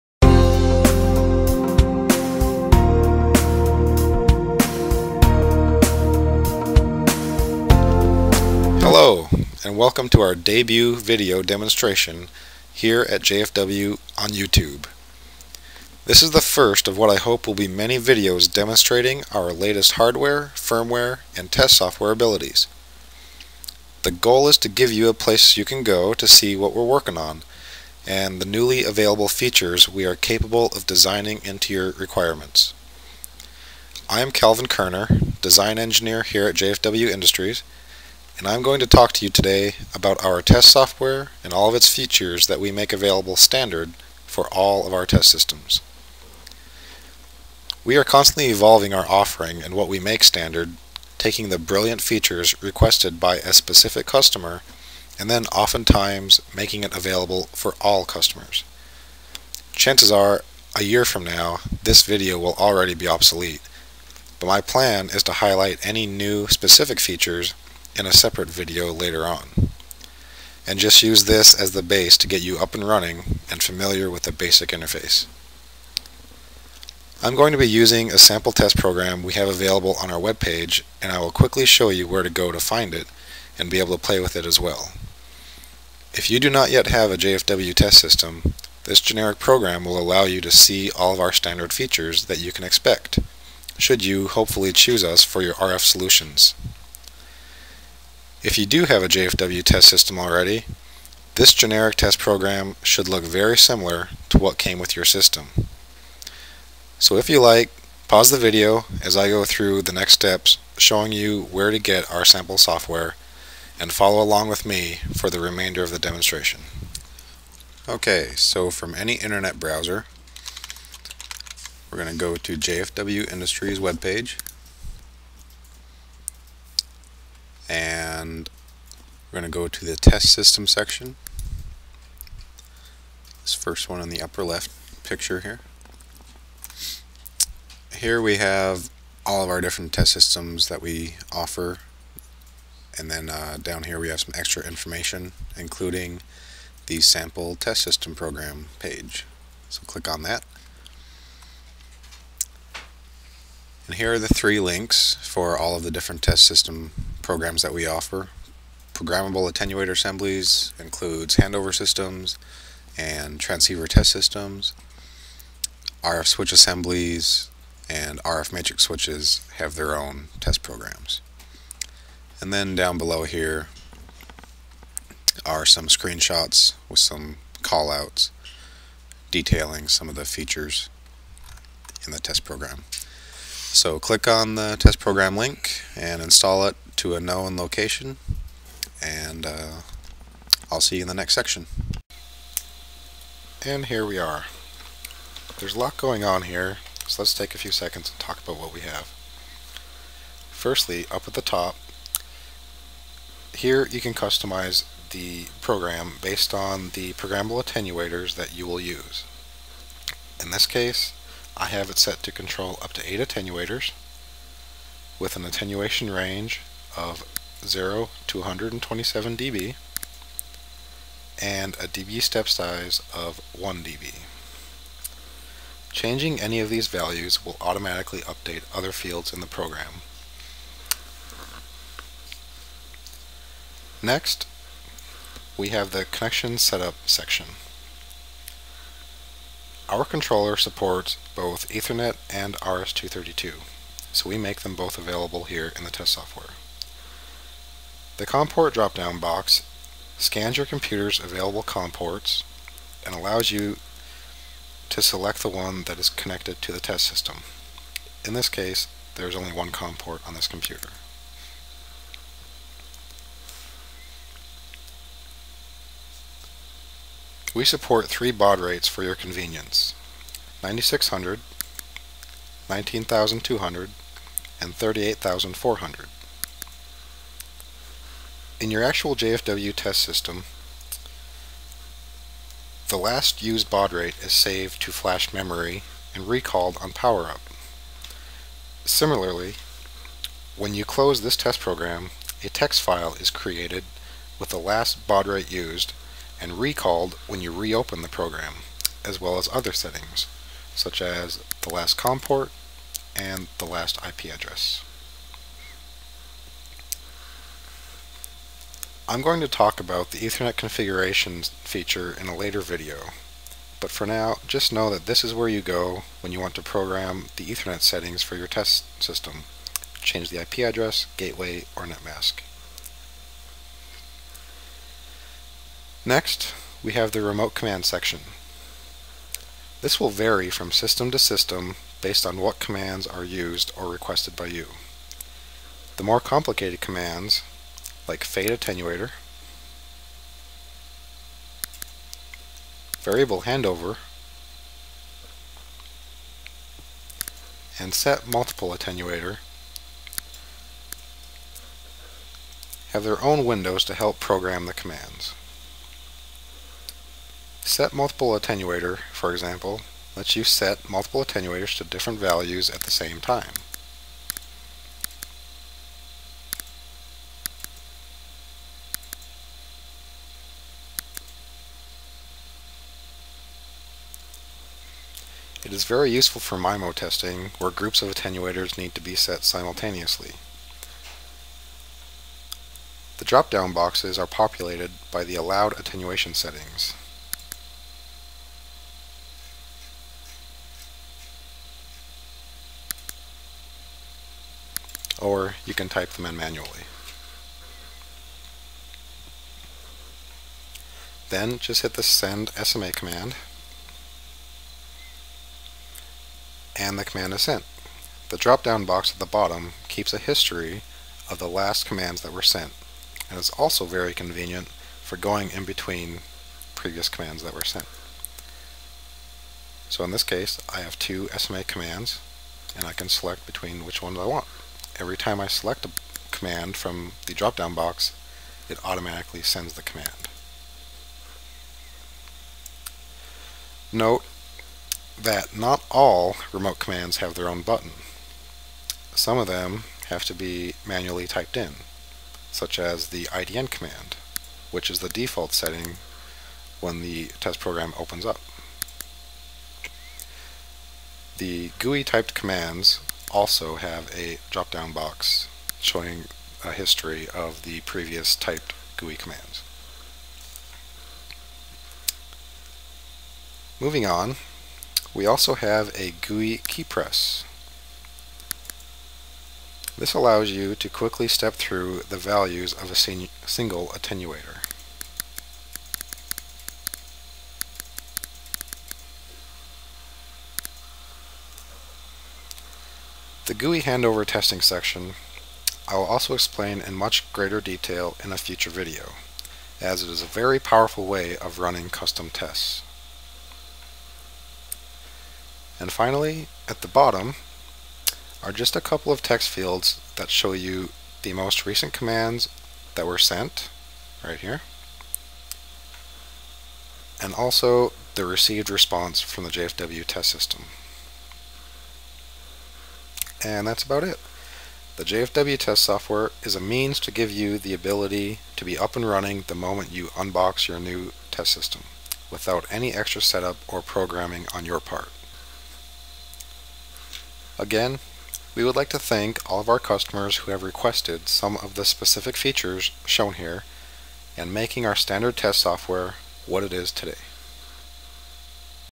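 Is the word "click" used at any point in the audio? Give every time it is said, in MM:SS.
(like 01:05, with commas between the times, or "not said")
02:29, 03:03.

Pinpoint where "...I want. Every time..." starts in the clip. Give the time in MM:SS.
07:04.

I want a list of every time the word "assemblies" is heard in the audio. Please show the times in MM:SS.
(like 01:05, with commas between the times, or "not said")
02:39, 02:46.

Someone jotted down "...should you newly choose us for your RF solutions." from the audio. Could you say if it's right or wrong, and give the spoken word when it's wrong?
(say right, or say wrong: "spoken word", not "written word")
wrong: "hopefully", not "newly".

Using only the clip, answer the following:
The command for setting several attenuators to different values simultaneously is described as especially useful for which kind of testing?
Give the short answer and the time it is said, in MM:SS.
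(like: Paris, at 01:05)
MIMO testing, at 06:16.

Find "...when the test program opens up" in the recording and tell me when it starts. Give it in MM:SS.
07:26.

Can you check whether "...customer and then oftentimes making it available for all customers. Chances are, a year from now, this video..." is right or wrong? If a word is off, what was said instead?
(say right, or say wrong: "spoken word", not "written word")
right.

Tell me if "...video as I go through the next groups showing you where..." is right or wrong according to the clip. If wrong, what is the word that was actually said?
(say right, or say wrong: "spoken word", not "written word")
wrong: "steps", not "groups".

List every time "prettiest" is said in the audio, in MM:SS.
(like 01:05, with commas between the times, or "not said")
not said.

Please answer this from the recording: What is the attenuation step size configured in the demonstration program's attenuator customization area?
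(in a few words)
1 dB.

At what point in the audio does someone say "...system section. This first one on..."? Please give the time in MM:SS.
02:10.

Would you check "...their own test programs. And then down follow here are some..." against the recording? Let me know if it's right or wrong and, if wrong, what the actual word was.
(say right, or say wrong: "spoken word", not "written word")
wrong: "below", not "follow".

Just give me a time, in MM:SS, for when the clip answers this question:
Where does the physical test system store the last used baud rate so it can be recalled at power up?
04:44.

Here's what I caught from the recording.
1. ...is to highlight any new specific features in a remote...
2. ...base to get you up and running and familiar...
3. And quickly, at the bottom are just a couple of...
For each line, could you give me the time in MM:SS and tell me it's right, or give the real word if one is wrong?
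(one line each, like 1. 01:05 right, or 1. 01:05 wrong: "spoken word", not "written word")
1. 01:05 wrong: "separate", not "remote"
2. 01:11 right
3. 08:15 wrong: "finally", not "quickly".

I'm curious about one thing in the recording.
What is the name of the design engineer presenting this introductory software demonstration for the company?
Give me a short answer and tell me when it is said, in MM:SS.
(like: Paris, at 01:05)
Calvin Kerner, at 00:34.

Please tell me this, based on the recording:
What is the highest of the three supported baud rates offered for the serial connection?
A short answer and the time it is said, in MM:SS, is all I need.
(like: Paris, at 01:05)
38400, at 04:34.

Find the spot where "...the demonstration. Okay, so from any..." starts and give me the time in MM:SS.
01:55.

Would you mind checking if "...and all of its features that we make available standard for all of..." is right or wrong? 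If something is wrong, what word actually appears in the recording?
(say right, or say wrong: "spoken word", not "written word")
right.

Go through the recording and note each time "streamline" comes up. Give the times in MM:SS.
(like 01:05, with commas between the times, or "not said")
not said.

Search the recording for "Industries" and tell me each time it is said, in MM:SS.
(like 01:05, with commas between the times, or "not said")
00:37, 02:03.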